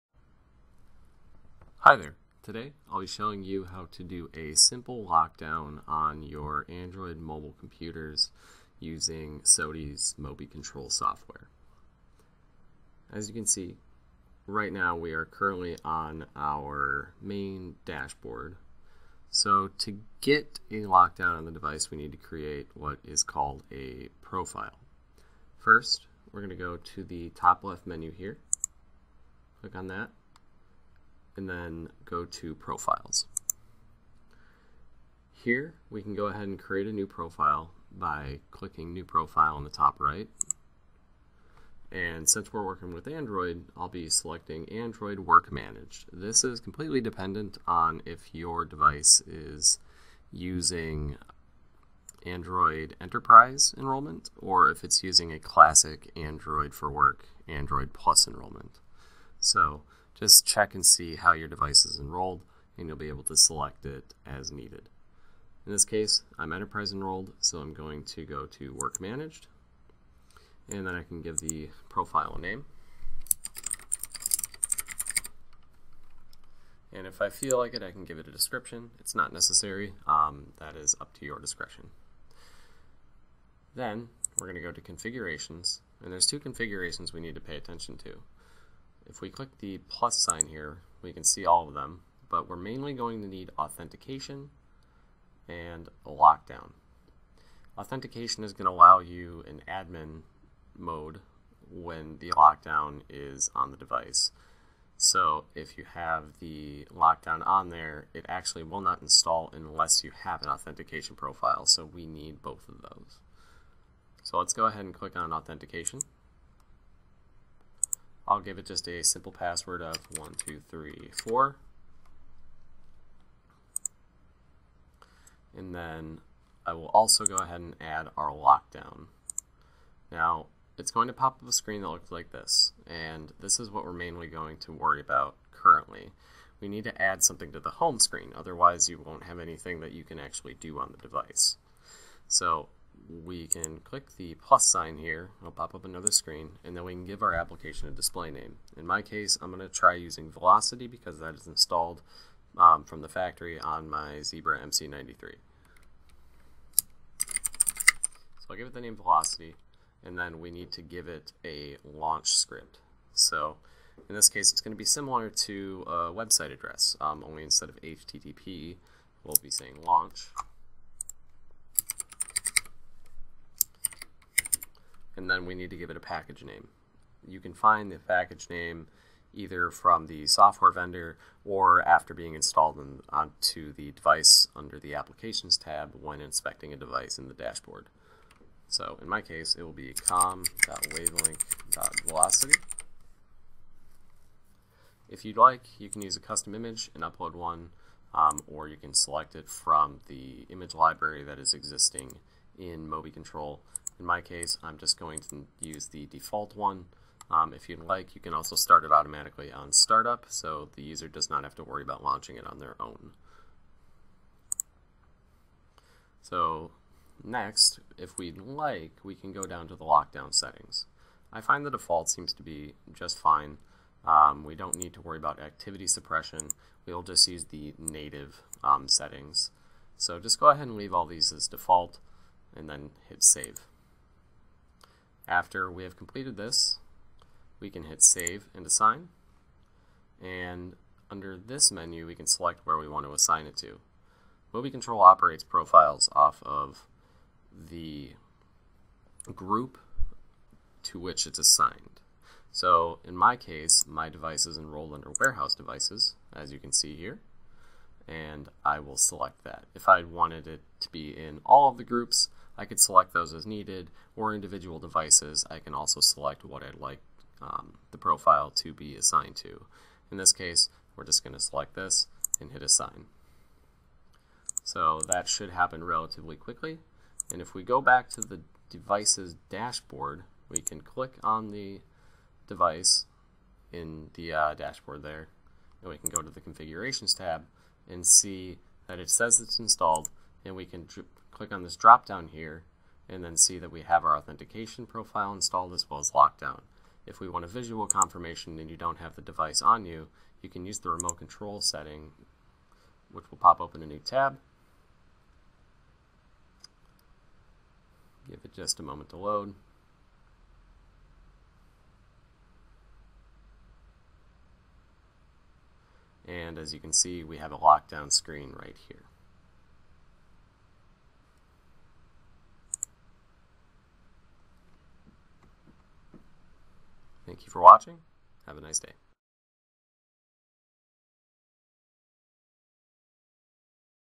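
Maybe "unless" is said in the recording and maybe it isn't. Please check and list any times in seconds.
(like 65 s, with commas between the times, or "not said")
109 s.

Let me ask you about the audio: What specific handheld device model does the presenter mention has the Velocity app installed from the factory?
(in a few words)
Zebra MC93.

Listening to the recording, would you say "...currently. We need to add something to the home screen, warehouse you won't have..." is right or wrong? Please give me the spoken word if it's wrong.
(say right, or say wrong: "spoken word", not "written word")
wrong: "otherwise", not "warehouse".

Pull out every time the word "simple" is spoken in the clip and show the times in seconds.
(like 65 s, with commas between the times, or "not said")
4 s, 119 s.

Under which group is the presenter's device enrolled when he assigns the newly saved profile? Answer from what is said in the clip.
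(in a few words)
Warehouse devices.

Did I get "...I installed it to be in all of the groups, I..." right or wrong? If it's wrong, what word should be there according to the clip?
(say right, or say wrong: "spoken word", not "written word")
wrong: "wanted", not "installed".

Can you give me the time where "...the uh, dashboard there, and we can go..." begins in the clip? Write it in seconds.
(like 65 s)
284 s.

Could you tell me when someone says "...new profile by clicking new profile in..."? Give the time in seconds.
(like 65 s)
36 s.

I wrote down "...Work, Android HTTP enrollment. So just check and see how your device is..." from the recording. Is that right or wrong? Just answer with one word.
wrong.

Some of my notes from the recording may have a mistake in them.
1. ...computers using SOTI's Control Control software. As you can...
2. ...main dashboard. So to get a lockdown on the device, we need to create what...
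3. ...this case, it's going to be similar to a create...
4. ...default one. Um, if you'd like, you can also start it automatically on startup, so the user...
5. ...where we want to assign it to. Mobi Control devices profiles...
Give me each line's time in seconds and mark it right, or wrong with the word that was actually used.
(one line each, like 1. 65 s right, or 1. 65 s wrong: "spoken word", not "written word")
1. 7 s wrong: "Mobi", not "Control"
2. 17 s right
3. 164 s wrong: "website", not "create"
4. 206 s right
5. 242 s wrong: "operates", not "devices".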